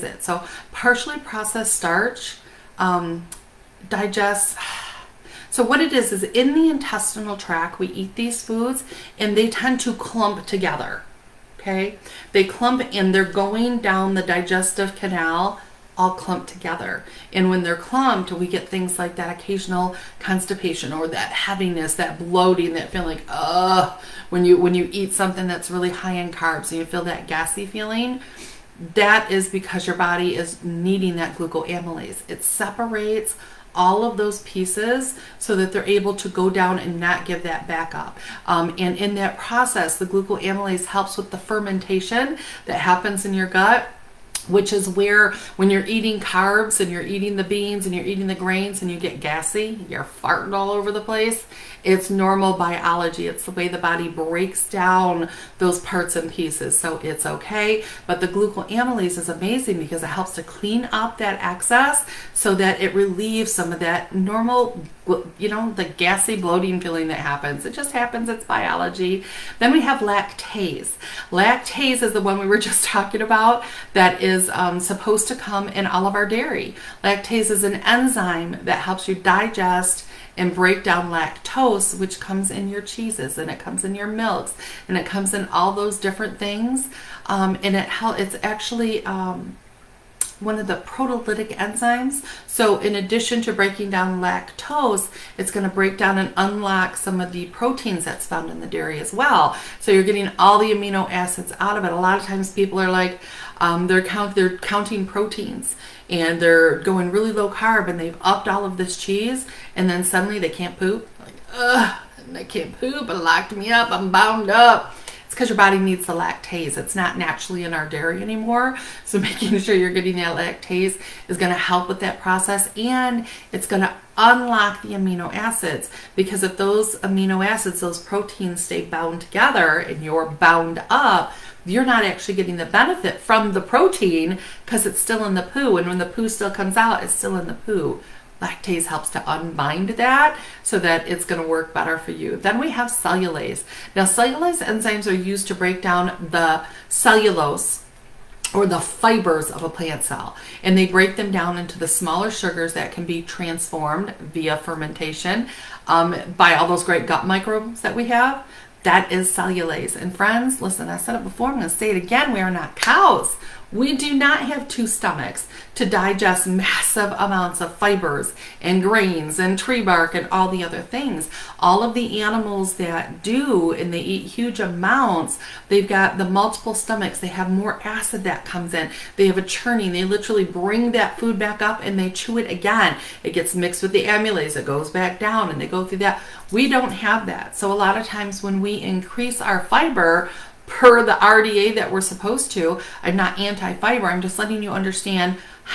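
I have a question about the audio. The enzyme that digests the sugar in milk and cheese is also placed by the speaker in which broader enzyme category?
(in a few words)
proteolytic enzymes.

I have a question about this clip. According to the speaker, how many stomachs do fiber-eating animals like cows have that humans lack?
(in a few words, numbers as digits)
2.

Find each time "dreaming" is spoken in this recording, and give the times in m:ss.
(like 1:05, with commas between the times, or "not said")
not said.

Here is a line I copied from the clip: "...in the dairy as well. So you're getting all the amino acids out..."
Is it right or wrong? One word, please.
right.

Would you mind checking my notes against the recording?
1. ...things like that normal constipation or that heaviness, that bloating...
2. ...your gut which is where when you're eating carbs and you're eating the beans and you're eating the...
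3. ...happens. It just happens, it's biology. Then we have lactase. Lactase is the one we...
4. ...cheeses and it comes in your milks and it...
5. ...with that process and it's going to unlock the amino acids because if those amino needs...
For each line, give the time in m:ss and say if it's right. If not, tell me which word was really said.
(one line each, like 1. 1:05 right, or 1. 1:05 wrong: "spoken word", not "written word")
1. 0:18 wrong: "occasional", not "normal"
2. 0:43 right
3. 1:07 right
4. 1:22 right
5. 2:01 wrong: "acids", not "needs".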